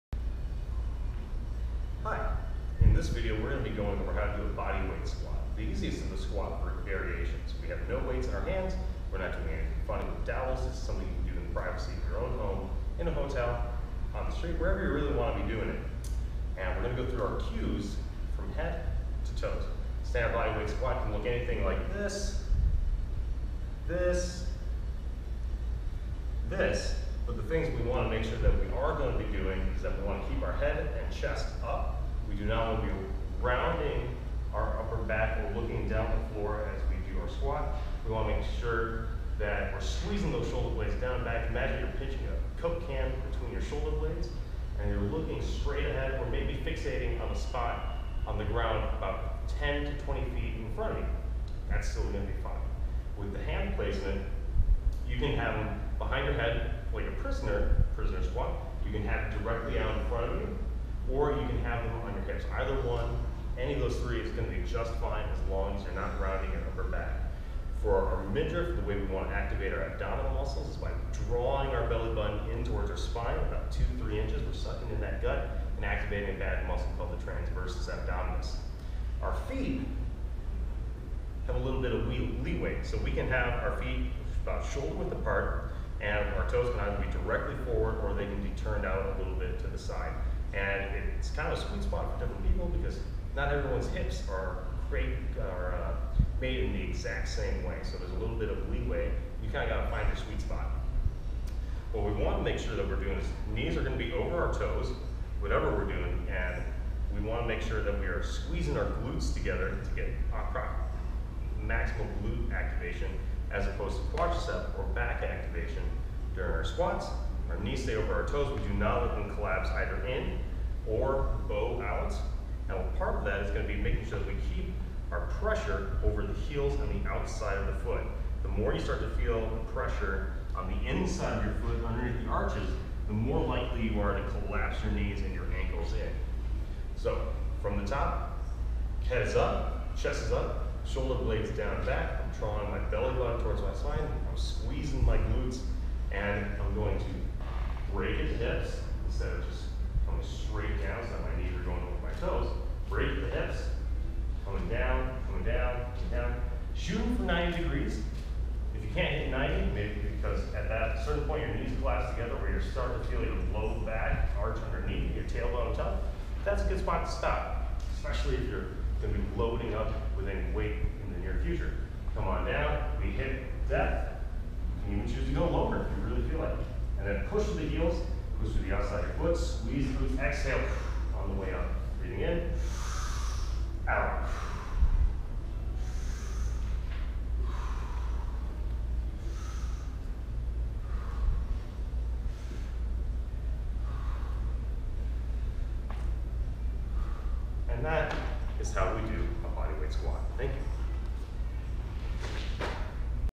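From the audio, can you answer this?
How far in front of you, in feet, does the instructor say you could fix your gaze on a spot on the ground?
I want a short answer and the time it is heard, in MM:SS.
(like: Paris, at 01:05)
10 to 20 feet, at 00:49.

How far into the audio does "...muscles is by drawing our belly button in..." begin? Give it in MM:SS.
01:10.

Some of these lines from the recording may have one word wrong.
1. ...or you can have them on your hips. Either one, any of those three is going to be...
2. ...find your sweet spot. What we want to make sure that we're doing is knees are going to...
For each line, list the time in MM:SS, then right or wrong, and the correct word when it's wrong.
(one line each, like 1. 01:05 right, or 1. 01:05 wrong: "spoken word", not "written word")
1. 01:01 right
2. 01:39 right.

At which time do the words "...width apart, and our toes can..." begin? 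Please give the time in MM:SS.
01:24.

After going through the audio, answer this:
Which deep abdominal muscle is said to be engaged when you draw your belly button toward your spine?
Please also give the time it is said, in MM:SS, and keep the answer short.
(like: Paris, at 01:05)
transversus abdominis, at 01:17.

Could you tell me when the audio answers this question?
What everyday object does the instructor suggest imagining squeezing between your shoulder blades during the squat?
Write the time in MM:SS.
00:42.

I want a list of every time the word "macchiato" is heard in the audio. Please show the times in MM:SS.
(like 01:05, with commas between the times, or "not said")
not said.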